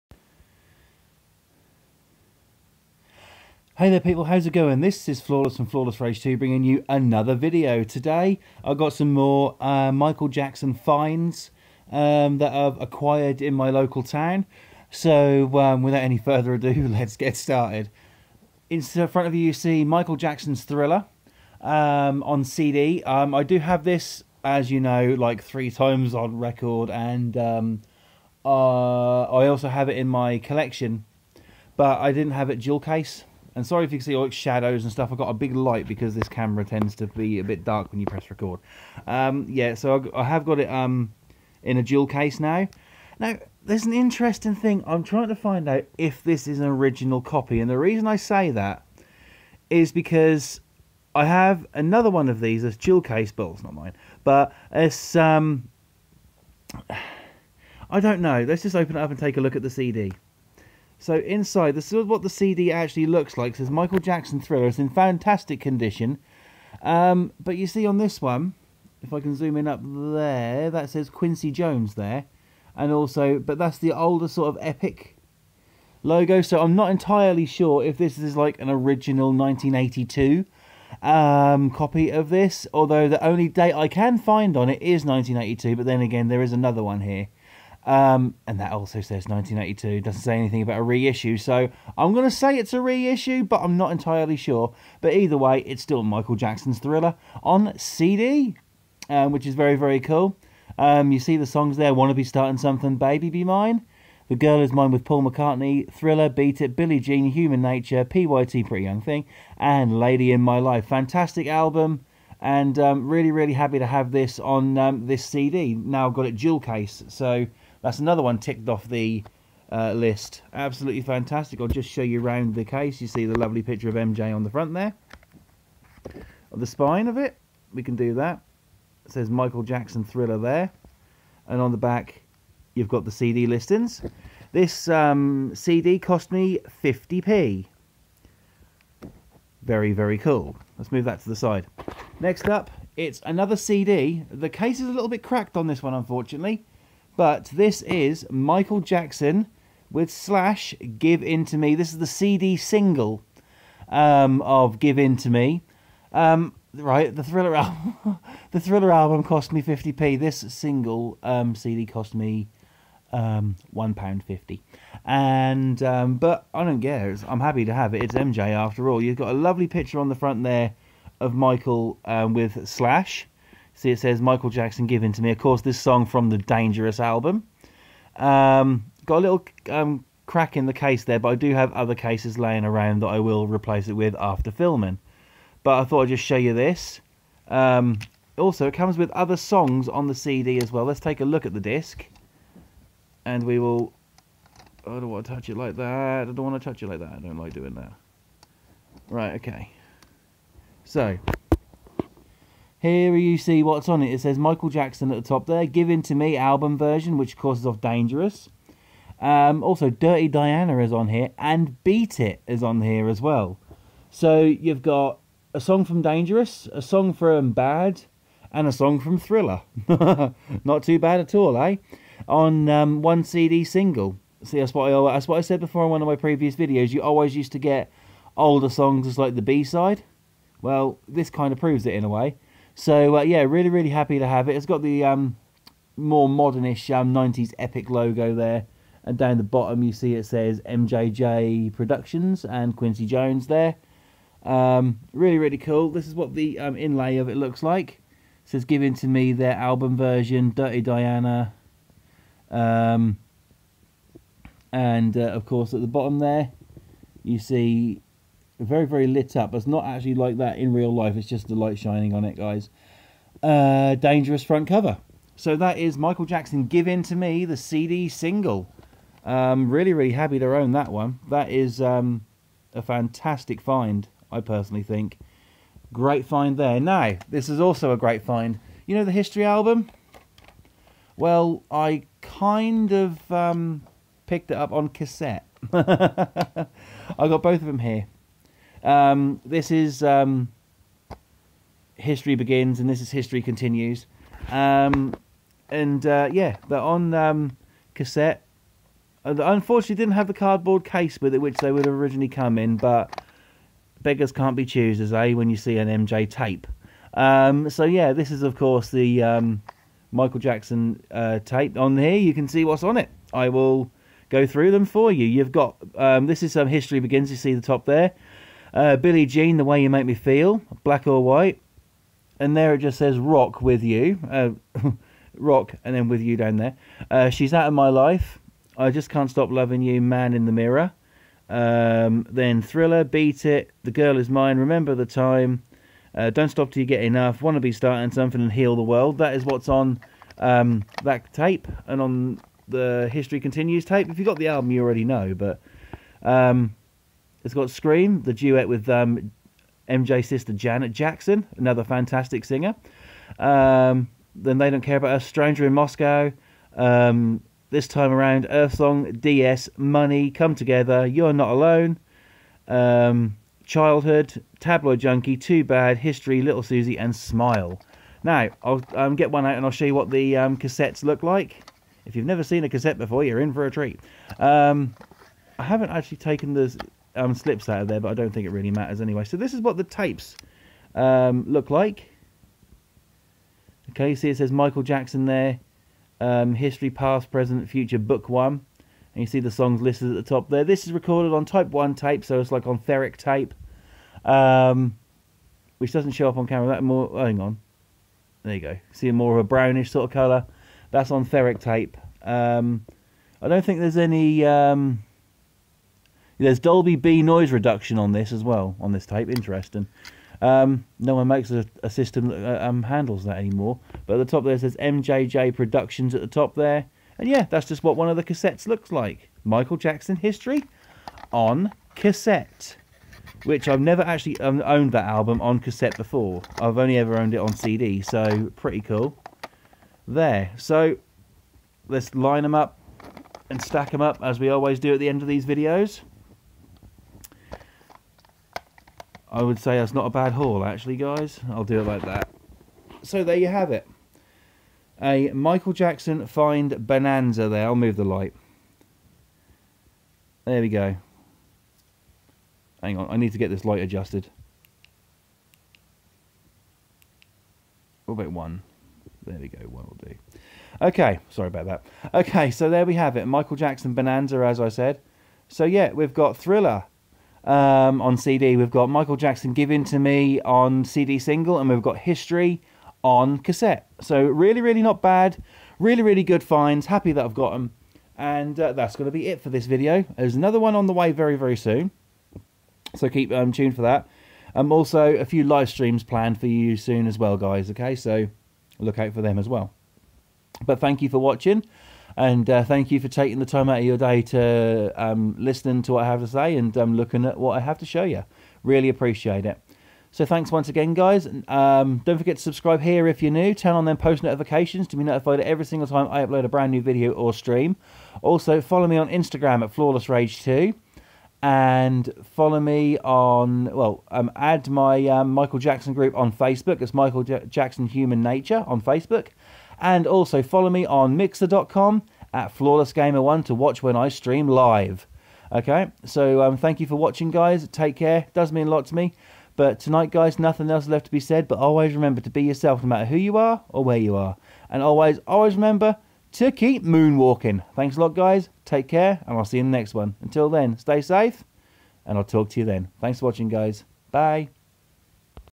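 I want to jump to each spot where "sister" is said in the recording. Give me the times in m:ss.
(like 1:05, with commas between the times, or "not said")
5:50.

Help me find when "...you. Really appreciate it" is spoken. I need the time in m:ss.
8:18.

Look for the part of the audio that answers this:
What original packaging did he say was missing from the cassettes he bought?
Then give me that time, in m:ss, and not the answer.
5:00.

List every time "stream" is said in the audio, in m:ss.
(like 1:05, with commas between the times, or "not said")
8:05, 8:27, 8:44.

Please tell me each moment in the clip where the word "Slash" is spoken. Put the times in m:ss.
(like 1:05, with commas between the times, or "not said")
2:30, 2:52.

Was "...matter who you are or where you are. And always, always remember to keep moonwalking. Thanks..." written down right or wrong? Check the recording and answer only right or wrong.
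right.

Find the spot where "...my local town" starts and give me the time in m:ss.
0:13.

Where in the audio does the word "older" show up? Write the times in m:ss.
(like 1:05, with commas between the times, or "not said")
1:13, 3:48.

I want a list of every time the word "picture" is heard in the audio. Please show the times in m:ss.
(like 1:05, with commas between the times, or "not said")
2:03, 2:49.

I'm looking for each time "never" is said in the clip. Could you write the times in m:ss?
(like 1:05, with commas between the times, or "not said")
6:12, 7:03.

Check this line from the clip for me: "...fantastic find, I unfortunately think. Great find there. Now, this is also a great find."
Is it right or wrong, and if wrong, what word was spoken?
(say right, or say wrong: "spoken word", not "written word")
wrong: "personally", not "unfortunately".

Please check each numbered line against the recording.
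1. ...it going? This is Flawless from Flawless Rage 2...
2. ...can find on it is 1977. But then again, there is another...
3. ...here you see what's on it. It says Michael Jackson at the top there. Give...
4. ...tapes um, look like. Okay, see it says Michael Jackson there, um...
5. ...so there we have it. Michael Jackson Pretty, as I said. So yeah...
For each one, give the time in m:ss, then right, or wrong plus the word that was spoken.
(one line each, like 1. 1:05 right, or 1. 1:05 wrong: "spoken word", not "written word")
1. 0:04 right
2. 1:23 wrong: "1982", not "1977"
3. 3:22 right
4. 6:19 right
5. 7:42 wrong: "Bonanza", not "Pretty".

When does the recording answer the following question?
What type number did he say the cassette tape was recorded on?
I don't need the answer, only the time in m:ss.
6:31.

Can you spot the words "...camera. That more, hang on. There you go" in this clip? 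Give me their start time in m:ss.
6:36.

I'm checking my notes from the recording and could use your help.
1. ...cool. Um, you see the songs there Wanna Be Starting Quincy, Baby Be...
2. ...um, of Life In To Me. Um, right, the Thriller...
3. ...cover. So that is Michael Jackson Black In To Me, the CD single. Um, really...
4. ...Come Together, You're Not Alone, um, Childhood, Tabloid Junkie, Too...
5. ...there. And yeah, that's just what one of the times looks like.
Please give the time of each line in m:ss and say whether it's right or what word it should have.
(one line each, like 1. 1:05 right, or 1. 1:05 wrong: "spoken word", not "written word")
1. 1:39 wrong: "Something", not "Quincy"
2. 2:33 wrong: "Give", not "Life"
3. 4:24 wrong: "Give", not "Black"
4. 6:00 right
5. 6:56 wrong: "cassettes", not "times".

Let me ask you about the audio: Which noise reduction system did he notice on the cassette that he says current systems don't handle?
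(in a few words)
Dolby B.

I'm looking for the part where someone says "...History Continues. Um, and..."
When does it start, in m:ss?
4:53.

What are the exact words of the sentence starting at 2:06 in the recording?
The spine of it, we can do that.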